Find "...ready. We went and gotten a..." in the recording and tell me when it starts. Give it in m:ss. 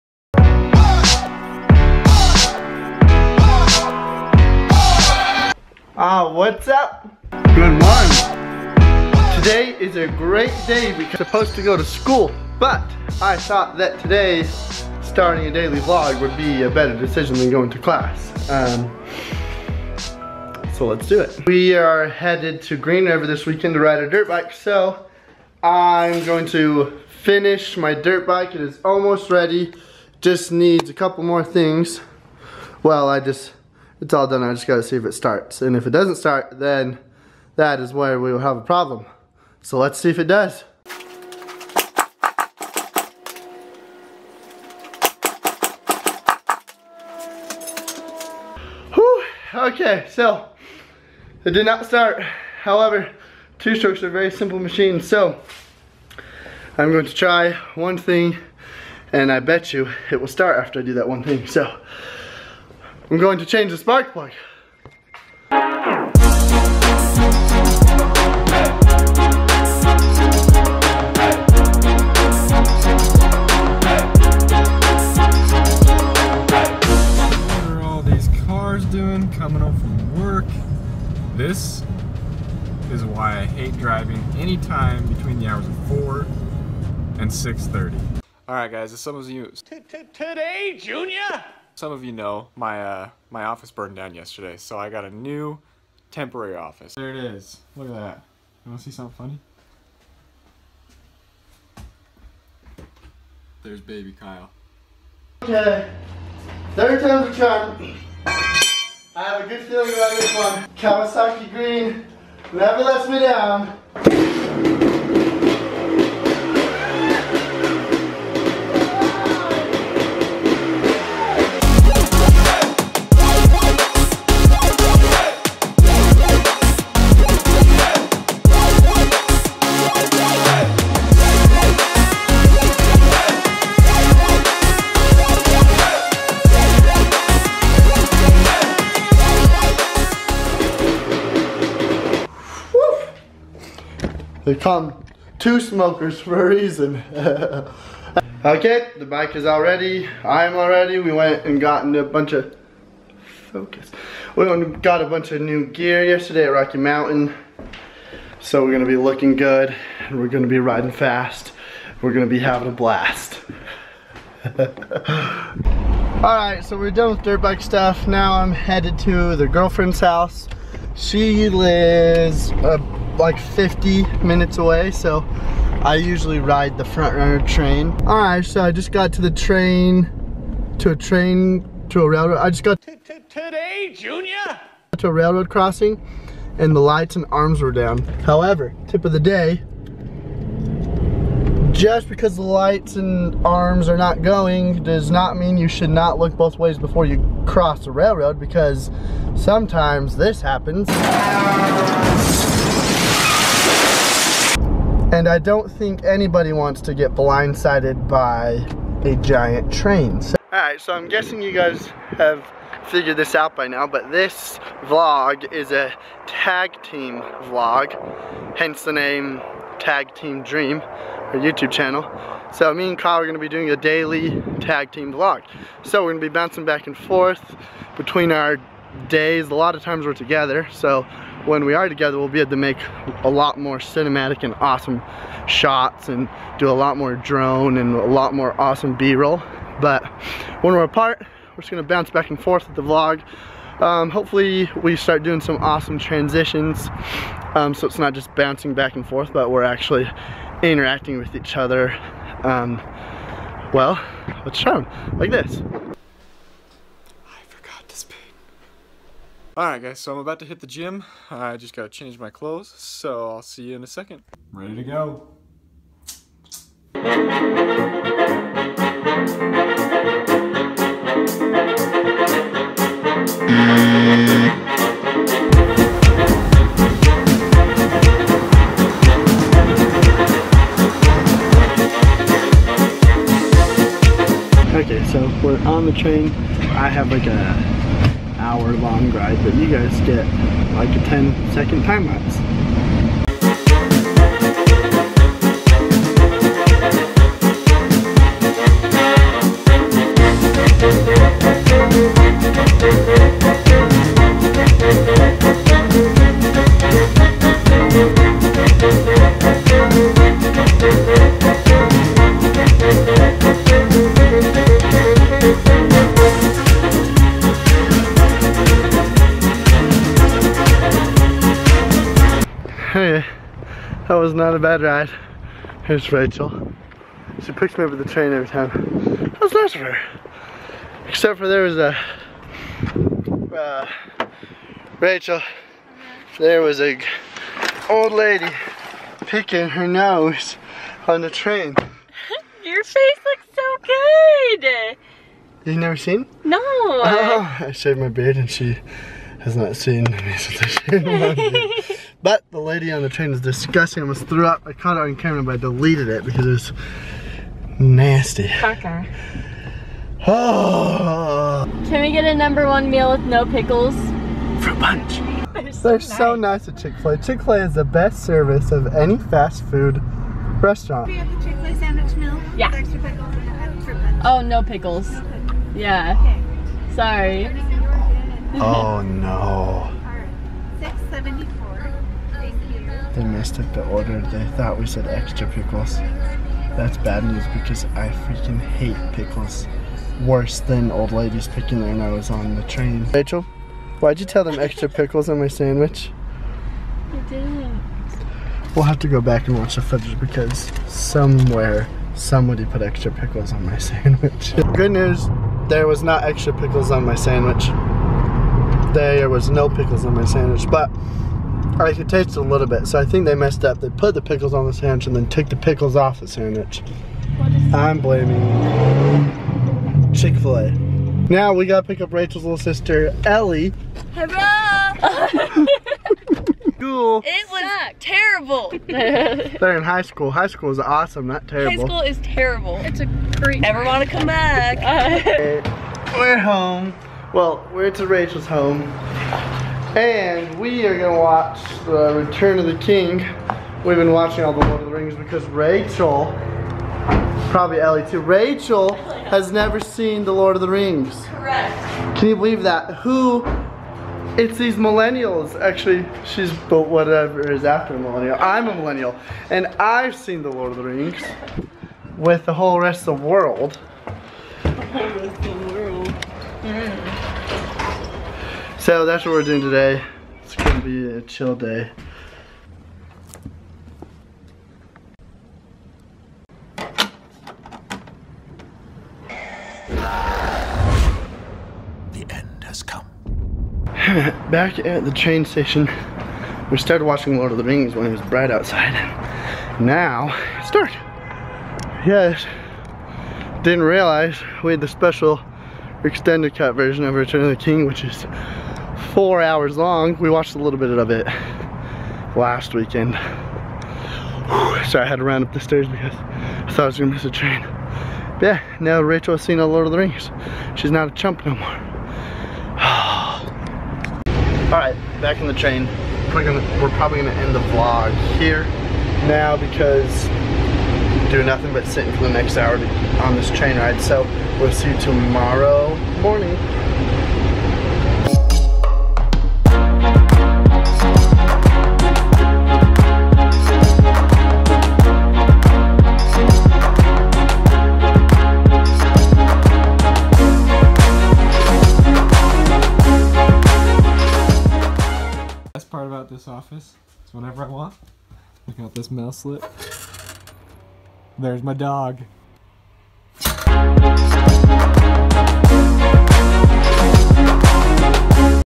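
2:30.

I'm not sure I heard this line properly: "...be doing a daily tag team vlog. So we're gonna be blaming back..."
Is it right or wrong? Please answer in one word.
wrong.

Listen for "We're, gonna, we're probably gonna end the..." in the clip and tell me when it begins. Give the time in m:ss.
8:36.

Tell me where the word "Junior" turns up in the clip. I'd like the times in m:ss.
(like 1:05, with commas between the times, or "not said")
1:30, 3:03.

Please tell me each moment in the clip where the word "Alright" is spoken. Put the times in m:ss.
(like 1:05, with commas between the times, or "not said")
1:28, 3:30, 4:19.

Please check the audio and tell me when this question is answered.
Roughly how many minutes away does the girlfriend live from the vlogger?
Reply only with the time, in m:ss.
2:53.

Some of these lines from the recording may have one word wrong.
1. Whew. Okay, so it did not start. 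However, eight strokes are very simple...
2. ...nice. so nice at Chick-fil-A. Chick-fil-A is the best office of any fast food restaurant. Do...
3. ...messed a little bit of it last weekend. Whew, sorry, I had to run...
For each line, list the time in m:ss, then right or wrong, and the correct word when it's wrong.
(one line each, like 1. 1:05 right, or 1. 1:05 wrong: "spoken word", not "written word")
1. 0:48 wrong: "two", not "eight"
2. 6:06 wrong: "service", not "office"
3. 8:20 wrong: "watched", not "messed".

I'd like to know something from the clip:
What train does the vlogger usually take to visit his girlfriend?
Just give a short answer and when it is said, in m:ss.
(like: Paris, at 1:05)
FrontRunner, at 2:56.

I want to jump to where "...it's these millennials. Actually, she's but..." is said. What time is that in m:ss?
7:34.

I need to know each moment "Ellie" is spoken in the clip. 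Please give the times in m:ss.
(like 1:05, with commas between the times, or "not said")
7:03, 7:27.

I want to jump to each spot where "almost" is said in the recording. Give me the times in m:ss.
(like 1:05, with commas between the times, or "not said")
0:28, 5:54.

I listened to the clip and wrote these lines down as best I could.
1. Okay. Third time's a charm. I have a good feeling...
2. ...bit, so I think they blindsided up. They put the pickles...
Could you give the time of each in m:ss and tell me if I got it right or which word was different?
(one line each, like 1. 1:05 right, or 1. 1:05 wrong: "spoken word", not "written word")
1. 1:45 right
2. 6:52 wrong: "messed", not "blindsided".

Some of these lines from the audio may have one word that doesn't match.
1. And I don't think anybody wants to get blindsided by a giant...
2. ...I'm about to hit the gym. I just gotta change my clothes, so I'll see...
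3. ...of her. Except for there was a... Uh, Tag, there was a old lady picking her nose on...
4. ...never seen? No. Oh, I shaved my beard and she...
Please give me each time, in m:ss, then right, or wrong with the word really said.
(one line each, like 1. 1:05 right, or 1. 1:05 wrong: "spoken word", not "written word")
1. 3:25 right
2. 4:20 right
3. 5:29 wrong: "Rachel", not "Tag"
4. 5:45 right.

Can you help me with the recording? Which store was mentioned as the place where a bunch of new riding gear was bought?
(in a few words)
Rocky Mountain.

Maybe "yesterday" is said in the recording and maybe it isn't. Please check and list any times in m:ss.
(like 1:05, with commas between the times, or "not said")
1:34, 2:36.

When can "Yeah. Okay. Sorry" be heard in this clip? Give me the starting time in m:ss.
6:15.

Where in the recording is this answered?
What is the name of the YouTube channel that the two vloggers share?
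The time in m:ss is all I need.
3:39.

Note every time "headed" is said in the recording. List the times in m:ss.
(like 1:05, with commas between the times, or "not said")
0:22, 2:48.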